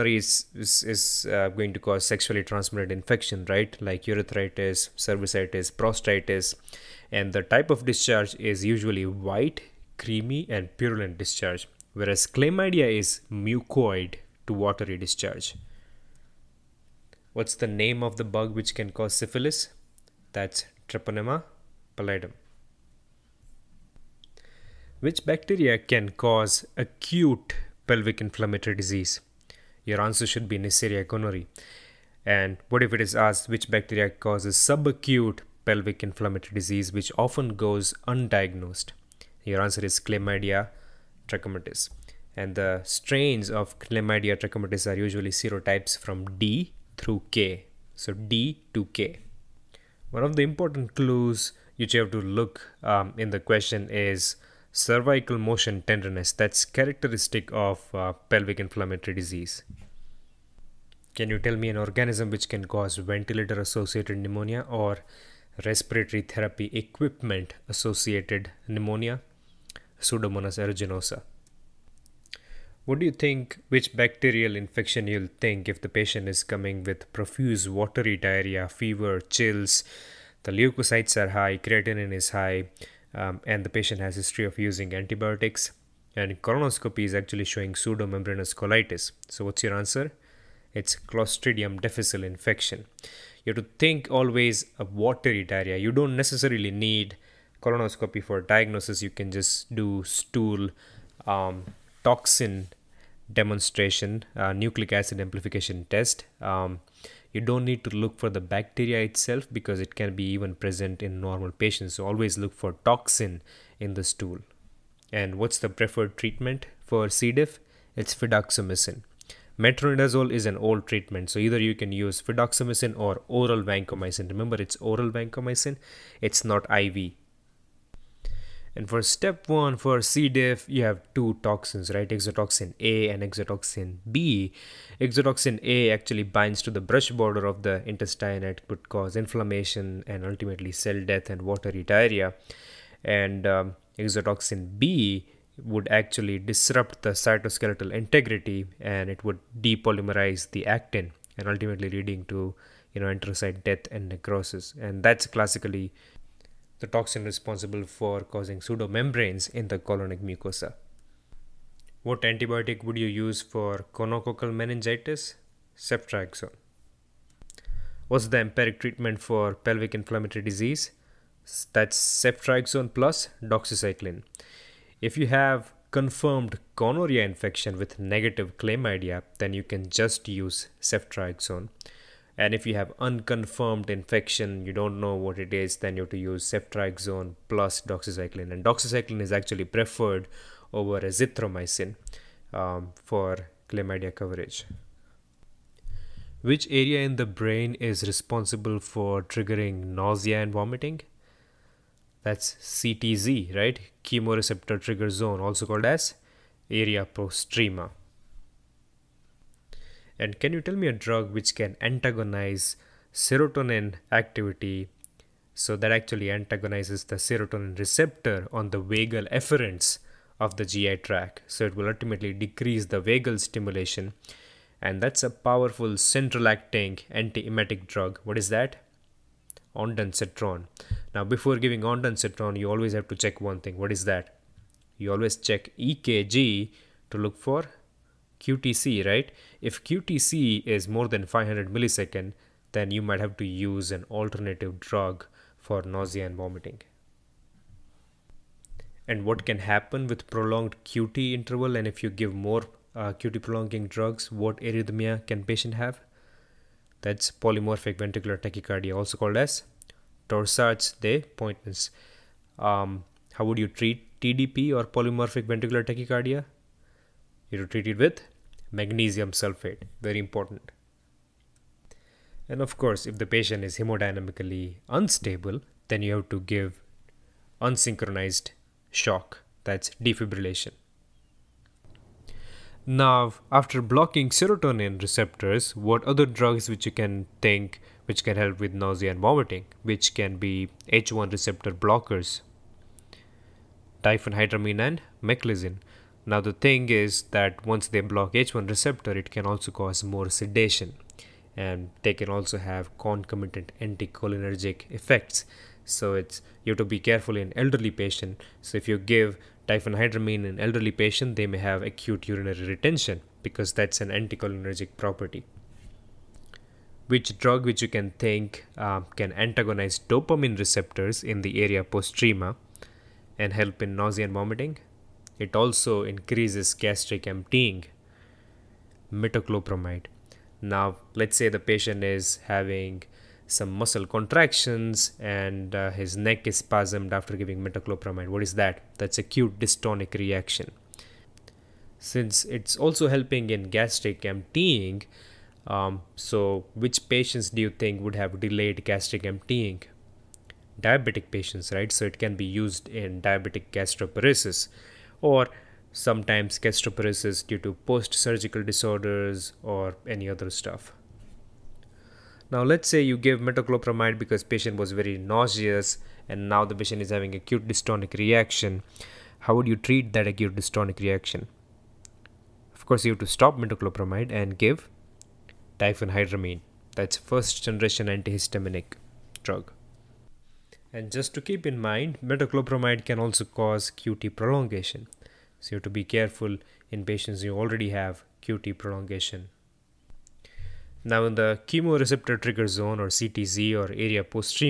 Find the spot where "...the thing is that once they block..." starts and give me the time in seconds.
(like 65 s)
296 s.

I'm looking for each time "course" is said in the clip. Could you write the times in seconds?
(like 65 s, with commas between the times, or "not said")
272 s, 372 s.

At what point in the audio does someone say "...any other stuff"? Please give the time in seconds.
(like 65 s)
360 s.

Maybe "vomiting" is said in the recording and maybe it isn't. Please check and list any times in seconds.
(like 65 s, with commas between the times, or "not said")
200 s, 246 s, 289 s, 324 s.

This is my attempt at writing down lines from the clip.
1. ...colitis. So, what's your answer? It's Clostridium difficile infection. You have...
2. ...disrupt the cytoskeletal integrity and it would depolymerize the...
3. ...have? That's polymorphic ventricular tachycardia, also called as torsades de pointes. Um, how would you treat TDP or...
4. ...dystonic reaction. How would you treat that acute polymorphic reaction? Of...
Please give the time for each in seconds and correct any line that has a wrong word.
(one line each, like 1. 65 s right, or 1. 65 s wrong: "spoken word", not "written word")
1. 88 s right
2. 146 s right
3. 255 s right
4. 367 s wrong: "dystonic", not "polymorphic".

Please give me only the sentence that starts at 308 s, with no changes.
So if you give diphenhydramine in elderly patient, they may have acute urinary retention because that's an anticholinergic property.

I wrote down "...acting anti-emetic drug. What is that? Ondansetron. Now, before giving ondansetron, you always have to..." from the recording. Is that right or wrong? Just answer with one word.
right.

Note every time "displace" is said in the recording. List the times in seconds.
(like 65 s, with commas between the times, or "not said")
not said.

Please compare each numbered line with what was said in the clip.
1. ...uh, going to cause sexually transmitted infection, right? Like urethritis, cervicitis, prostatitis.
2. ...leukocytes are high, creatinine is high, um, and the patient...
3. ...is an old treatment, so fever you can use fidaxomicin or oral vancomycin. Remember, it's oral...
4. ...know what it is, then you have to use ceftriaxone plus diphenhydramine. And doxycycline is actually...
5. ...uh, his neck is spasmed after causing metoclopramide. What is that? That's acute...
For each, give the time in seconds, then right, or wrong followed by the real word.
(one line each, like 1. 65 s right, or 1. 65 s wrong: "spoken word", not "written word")
1. 1 s right
2. 80 s right
3. 120 s wrong: "either", not "fever"
4. 184 s wrong: "doxycycline", not "diphenhydramine"
5. 335 s wrong: "giving", not "causing".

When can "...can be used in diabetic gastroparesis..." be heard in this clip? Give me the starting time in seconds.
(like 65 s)
352 s.